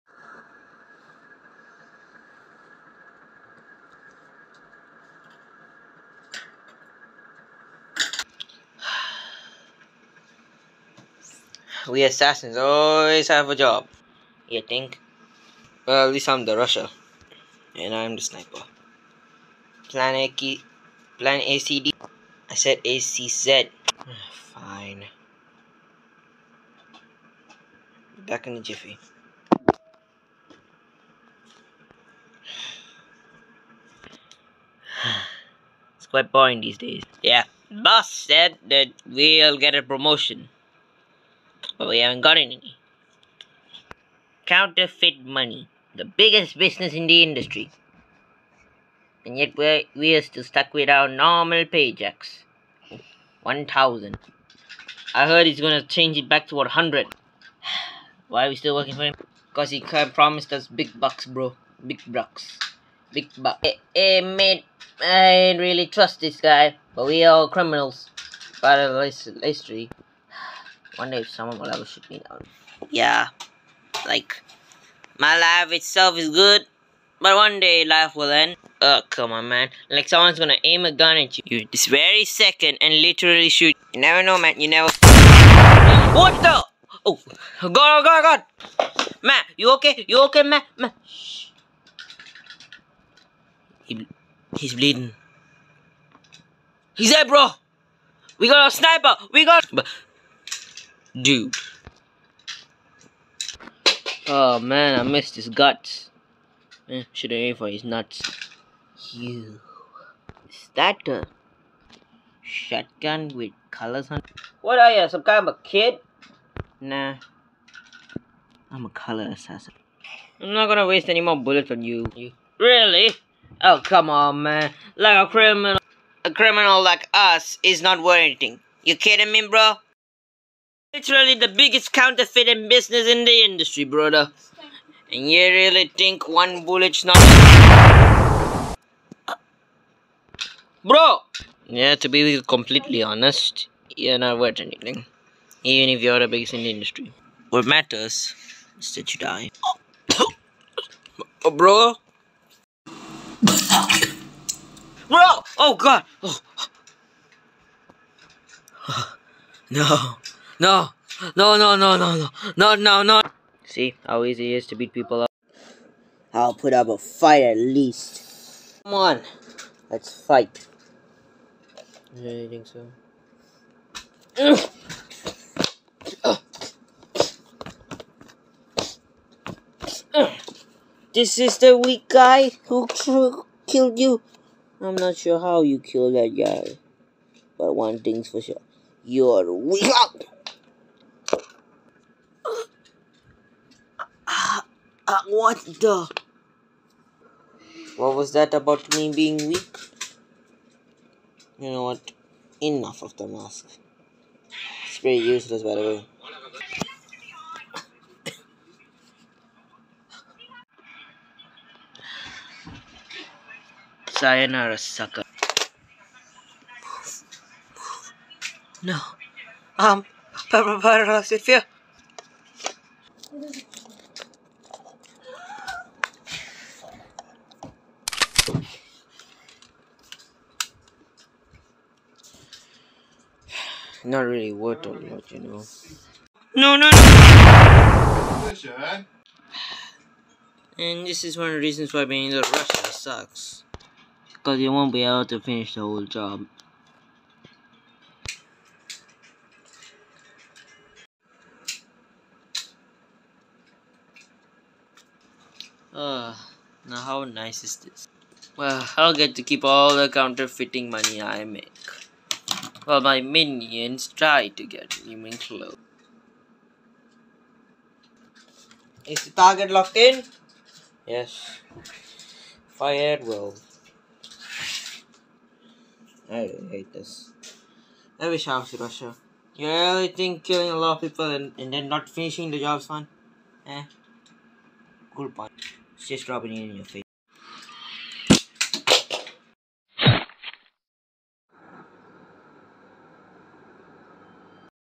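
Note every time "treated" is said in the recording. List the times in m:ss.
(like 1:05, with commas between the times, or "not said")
not said.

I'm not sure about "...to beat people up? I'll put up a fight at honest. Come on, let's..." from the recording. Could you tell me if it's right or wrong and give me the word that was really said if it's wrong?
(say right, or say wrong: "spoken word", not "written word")
wrong: "least", not "honest".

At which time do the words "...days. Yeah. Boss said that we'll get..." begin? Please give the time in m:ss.
0:36.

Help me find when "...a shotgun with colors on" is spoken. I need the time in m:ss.
1:51.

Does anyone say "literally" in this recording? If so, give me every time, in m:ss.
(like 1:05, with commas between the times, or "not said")
1:23, 2:10.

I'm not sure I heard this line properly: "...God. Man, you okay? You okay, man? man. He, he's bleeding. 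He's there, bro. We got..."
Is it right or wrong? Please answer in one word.
right.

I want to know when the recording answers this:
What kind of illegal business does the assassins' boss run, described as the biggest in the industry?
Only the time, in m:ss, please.
0:44.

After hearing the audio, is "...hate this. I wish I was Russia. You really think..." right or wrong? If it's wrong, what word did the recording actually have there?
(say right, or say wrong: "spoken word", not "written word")
right.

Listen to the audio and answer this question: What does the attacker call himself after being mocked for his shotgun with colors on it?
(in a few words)
Color assassin.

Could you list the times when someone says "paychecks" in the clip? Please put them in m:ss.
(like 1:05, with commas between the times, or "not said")
0:51.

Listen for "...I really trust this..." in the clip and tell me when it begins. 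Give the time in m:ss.
1:05.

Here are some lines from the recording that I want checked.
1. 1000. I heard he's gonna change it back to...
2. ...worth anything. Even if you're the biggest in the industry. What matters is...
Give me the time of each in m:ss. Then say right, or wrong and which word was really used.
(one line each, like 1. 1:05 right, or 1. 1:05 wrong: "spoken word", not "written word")
1. 0:53 right
2. 2:24 right.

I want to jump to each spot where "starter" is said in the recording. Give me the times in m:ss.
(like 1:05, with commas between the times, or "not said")
not said.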